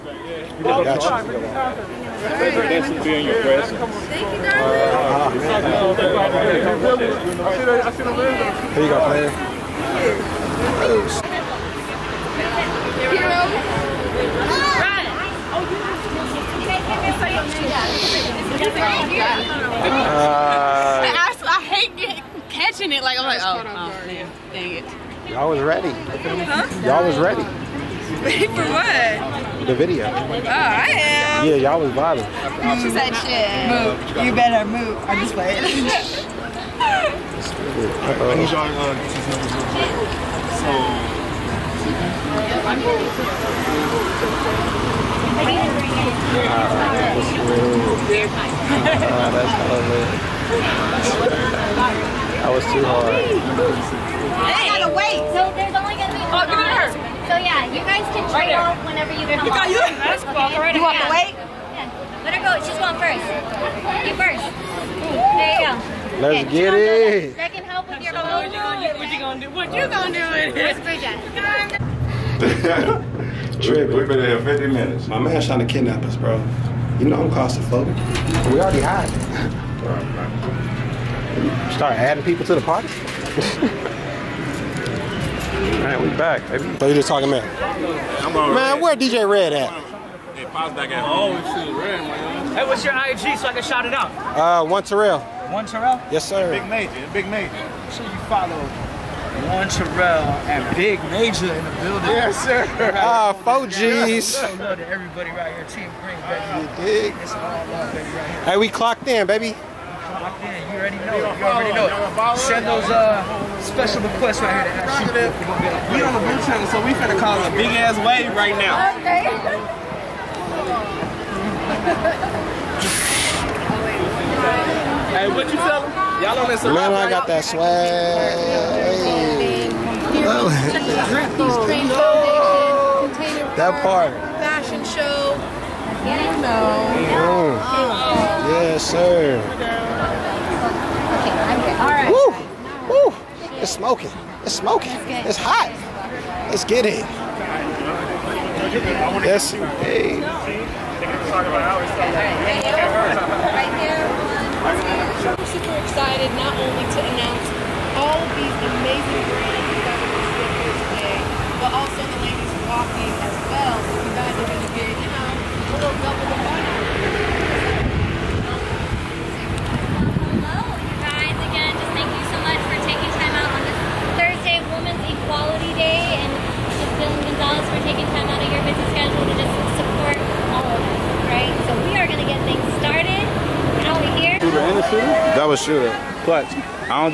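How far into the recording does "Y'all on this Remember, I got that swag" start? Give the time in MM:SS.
02:06.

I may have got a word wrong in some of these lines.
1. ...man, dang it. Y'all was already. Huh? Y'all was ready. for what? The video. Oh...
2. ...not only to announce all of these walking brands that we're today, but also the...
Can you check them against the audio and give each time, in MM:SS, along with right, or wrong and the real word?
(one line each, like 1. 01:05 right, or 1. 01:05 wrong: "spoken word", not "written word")
1. 00:24 wrong: "ready", not "already"
2. 02:36 wrong: "amazing", not "walking".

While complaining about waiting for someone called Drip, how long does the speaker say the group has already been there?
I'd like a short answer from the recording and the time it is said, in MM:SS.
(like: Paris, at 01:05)
50 minutes, at 01:14.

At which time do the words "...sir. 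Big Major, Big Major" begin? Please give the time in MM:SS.
01:36.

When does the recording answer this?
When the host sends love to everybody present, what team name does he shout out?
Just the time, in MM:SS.
01:45.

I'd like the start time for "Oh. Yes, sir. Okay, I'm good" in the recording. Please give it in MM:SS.
02:17.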